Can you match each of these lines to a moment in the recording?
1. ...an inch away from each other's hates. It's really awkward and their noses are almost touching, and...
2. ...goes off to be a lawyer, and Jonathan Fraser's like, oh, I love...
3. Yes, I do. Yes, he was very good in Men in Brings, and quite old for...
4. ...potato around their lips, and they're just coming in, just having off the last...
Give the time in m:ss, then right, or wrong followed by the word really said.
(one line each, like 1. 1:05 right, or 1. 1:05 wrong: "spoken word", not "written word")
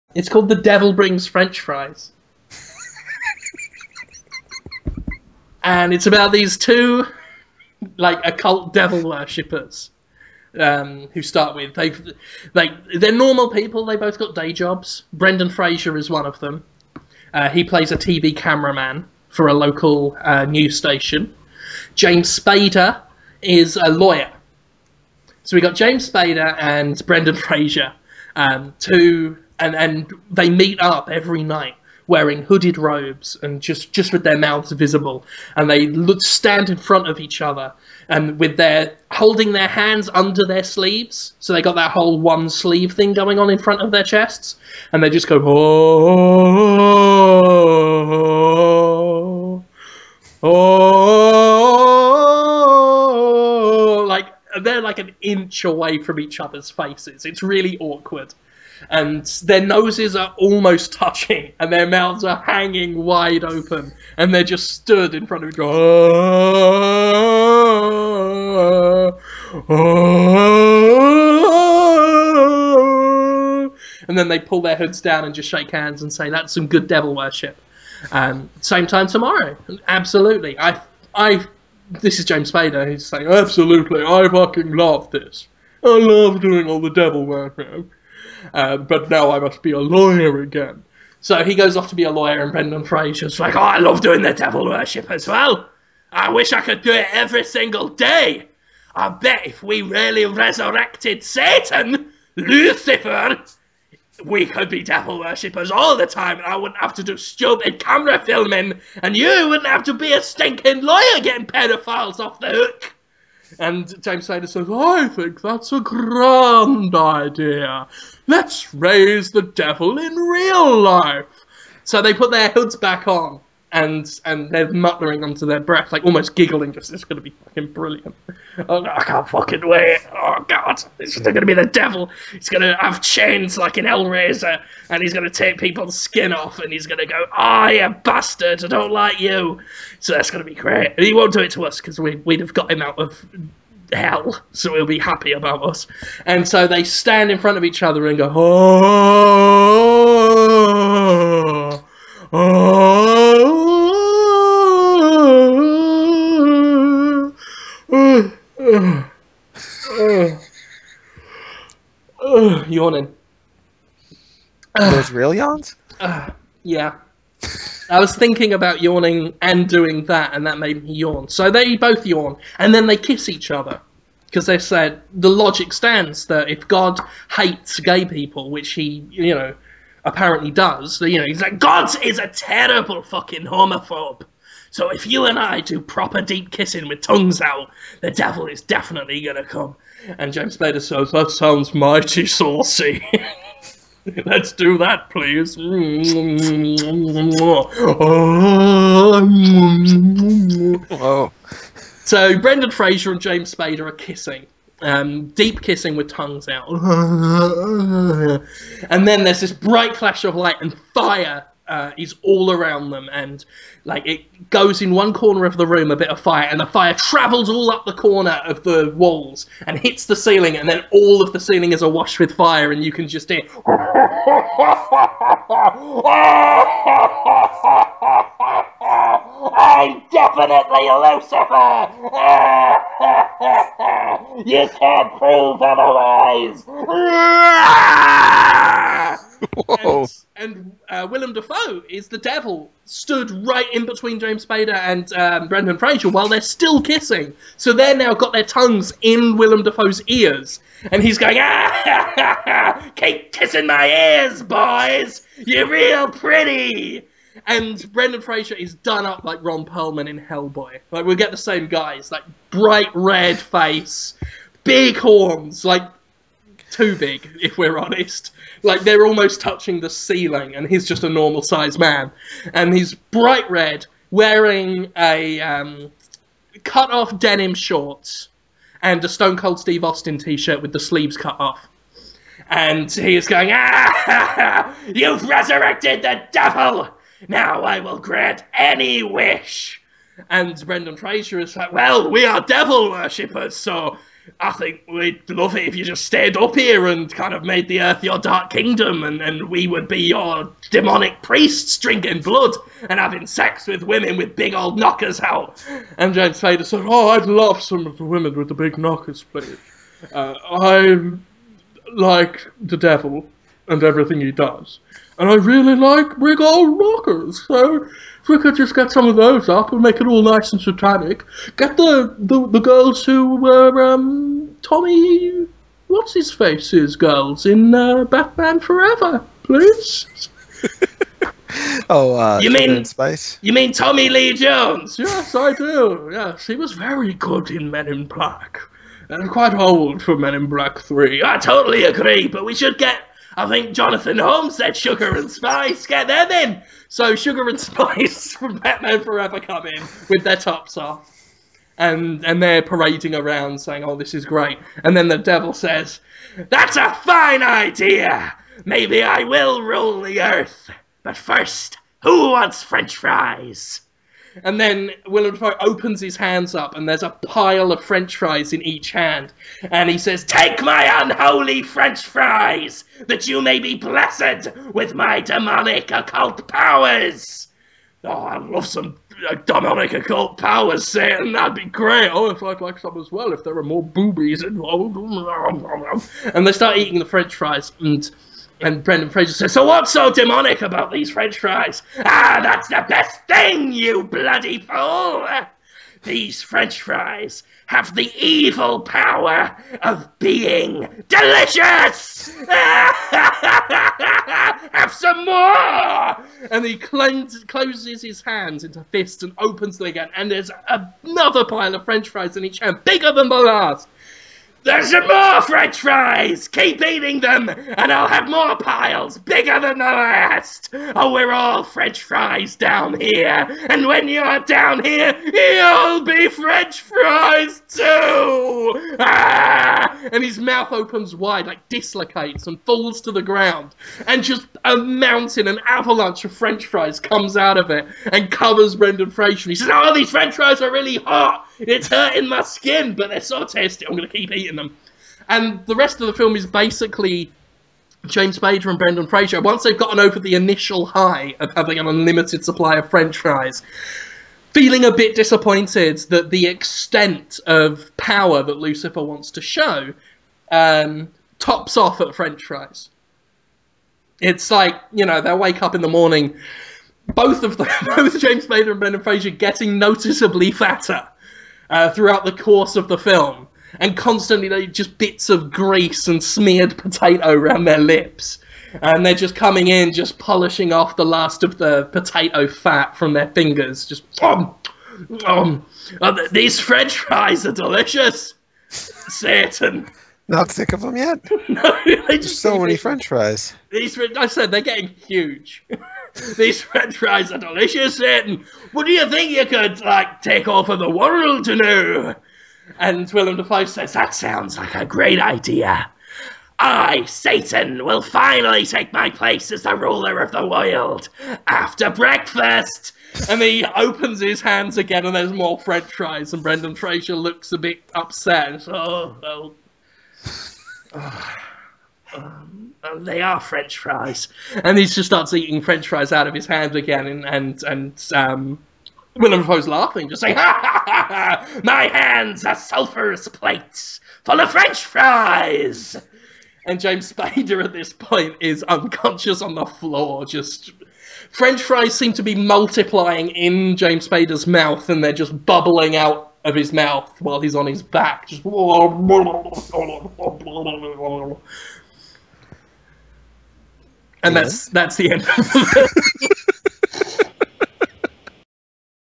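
1. 0:54 wrong: "faces", not "hates"
2. 1:31 wrong: "Brendan", not "Jonathan"
3. 5:34 wrong: "Black", not "Brings"
4. 7:56 wrong: "polishing", not "having".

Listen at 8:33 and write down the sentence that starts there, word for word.
and he opens his hands again, and there's more French fries.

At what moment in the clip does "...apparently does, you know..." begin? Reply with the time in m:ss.
3:00.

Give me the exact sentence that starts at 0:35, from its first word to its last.
And they look, stand in front of each other and with their holding their hands under their sleeves.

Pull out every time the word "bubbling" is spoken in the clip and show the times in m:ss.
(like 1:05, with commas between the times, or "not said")
9:05.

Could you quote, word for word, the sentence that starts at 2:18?
I don't like you." So that's gonna be great.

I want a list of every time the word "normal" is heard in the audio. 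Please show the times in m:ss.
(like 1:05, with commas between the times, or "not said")
0:13, 4:31.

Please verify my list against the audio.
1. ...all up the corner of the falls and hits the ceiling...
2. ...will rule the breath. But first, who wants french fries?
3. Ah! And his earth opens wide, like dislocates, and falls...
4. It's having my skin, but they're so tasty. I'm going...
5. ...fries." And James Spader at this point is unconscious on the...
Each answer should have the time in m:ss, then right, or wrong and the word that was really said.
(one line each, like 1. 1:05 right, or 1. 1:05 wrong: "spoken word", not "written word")
1. 3:37 wrong: "walls", not "falls"
2. 5:59 wrong: "earth", not "breath"
3. 7:08 wrong: "mouth", not "earth"
4. 7:21 wrong: "hurting", not "having"
5. 8:54 right.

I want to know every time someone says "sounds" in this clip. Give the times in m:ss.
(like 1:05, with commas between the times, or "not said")
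3:11, 8:24.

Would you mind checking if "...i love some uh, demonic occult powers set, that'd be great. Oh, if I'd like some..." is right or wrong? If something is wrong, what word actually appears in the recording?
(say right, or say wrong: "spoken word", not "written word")
right.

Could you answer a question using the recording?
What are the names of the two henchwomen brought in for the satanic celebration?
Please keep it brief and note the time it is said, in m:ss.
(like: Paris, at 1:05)
Sugar and Spice, at 5:44.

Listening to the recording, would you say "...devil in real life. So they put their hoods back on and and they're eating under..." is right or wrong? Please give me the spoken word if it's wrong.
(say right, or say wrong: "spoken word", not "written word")
wrong: "muttering", not "eating".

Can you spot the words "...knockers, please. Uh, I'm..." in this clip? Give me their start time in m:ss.
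5:08.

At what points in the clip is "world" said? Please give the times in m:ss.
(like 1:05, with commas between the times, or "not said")
8:20, 8:30.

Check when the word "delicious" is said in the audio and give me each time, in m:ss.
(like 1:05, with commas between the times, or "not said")
6:41, 8:07, 8:17.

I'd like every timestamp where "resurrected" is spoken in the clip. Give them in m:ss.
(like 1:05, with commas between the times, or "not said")
1:40, 4:45.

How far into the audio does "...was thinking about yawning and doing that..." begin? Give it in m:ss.
2:47.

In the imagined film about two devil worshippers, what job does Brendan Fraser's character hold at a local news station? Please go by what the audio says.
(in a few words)
TV cameraman.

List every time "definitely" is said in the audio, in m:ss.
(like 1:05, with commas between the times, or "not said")
3:08, 3:50.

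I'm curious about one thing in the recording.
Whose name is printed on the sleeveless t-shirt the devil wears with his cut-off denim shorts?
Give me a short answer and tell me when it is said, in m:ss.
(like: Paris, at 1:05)
Stone Cold Steve Austin, at 4:39.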